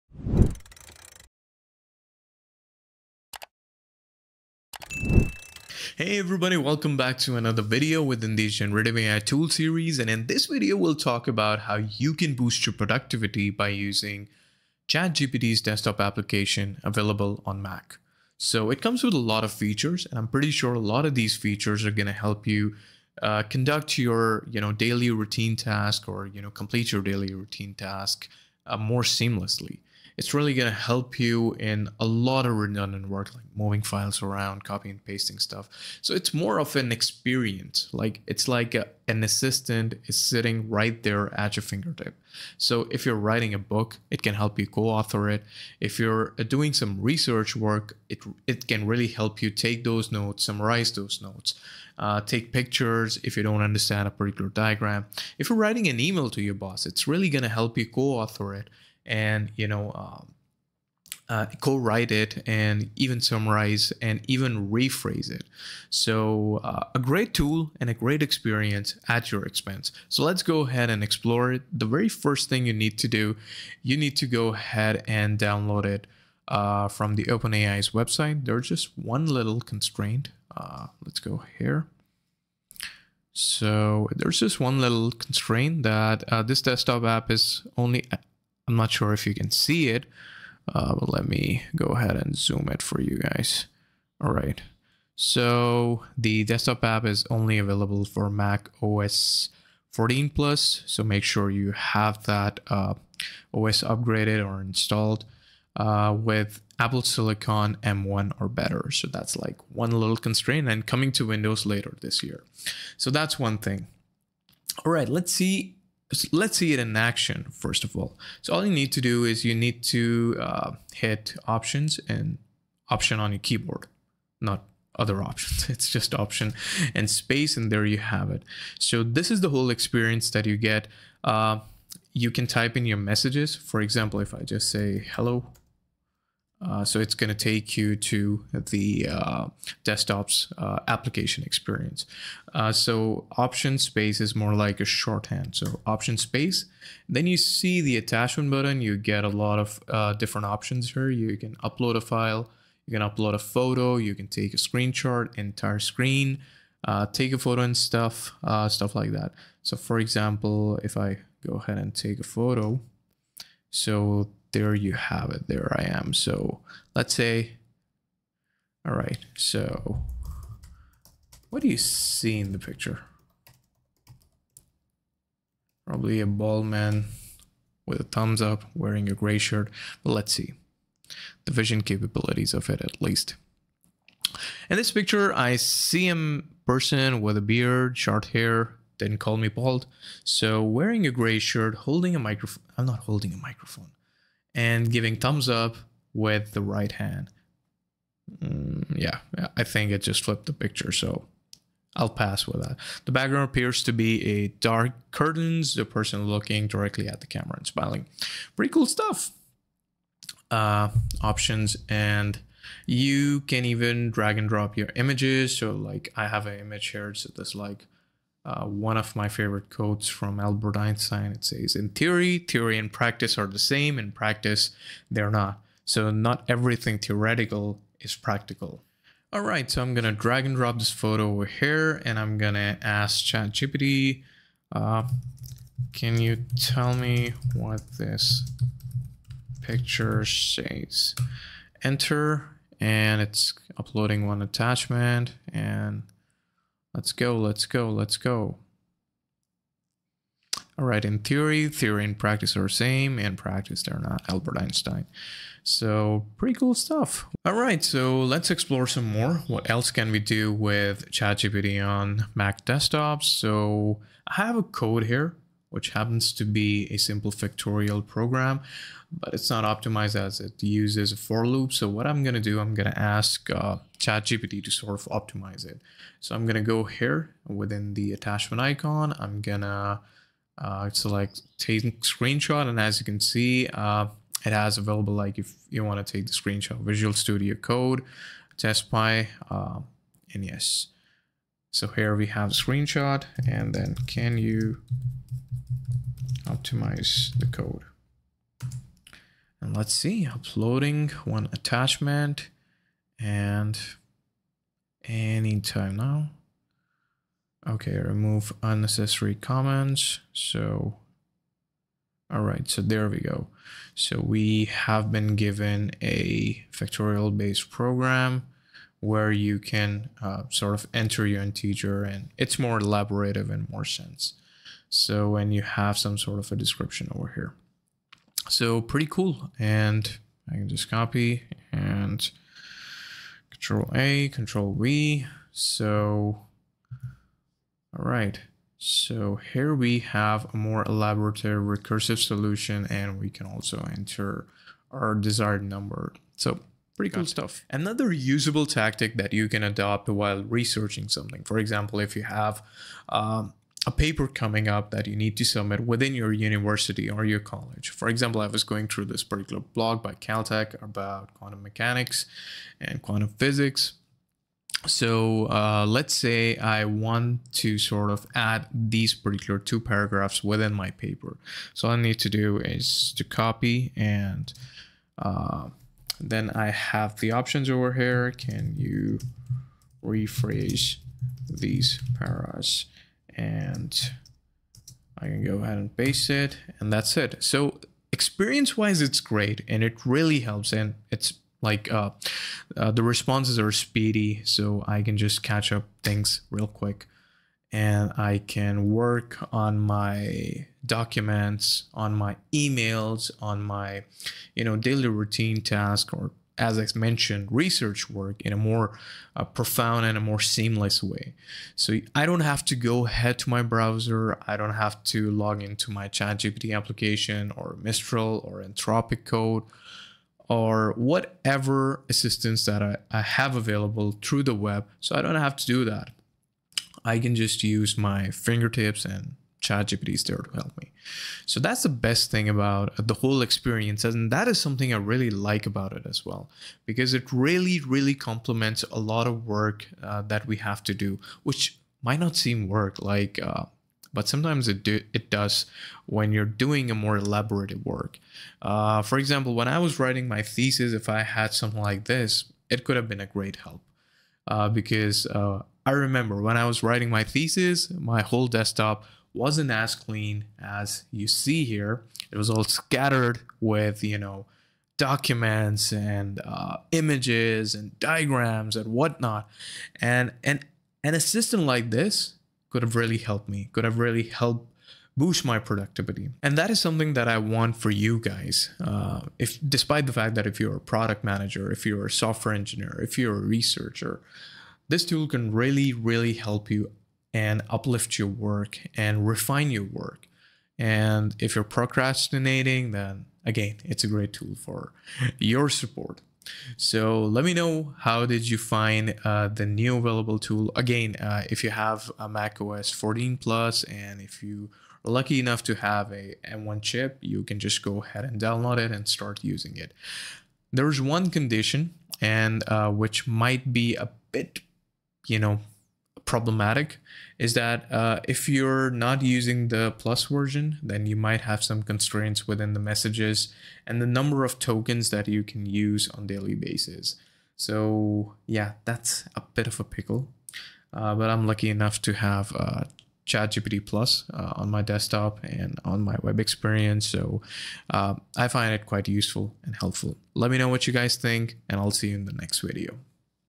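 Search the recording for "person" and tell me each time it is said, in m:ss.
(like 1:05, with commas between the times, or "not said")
3:06, 3:25.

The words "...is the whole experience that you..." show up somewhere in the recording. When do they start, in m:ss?
2:09.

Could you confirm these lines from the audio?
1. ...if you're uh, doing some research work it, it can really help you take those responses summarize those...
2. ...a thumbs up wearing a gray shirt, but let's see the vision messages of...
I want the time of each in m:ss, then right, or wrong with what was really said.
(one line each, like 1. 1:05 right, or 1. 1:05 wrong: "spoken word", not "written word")
1. 0:45 wrong: "notes", not "responses"
2. 2:57 wrong: "capabilities", not "messages".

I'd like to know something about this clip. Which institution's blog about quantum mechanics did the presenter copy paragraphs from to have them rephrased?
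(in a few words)
Caltech.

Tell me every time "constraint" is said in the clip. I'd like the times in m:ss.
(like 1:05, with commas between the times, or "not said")
1:19, 1:25, 1:50, 8:41.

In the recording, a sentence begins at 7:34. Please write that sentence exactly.
Uh, because uh, I remember when I was writing my thesis, my whole desktop wasn't as clean as you see here.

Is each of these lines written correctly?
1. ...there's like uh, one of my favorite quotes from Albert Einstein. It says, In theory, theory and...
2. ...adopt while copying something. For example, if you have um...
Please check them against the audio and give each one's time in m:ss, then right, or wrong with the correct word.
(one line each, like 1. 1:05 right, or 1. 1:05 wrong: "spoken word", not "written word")
1. 3:37 right
2. 5:49 wrong: "researching", not "copying".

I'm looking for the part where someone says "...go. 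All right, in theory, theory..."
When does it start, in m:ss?
4:08.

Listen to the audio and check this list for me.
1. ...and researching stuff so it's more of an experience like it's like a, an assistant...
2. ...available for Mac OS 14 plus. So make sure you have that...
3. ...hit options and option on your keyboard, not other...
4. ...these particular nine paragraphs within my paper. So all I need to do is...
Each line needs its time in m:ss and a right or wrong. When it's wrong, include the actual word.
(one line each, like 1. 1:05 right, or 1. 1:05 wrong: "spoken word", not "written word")
1. 0:34 wrong: "pasting", not "researching"
2. 1:37 right
3. 2:00 right
4. 6:08 wrong: "two", not "nine".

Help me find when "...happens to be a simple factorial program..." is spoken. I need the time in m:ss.
4:25.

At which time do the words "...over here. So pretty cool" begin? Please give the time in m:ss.
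5:27.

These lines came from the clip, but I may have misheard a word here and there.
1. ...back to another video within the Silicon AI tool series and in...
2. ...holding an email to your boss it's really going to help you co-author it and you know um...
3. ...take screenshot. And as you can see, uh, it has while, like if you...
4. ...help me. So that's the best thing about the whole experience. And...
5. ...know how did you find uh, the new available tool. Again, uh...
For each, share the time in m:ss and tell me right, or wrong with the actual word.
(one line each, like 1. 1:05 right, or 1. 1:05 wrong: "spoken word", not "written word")
1. 0:06 wrong: "Generative", not "Silicon"
2. 0:55 wrong: "writing", not "holding"
3. 4:41 wrong: "available", not "while"
4. 7:10 right
5. 8:17 right.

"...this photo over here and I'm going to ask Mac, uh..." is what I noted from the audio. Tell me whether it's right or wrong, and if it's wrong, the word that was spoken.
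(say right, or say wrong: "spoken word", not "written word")
wrong: "ChatGPT", not "Mac".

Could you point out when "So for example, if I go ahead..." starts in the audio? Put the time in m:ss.
2:39.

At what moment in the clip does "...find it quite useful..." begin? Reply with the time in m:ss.
8:58.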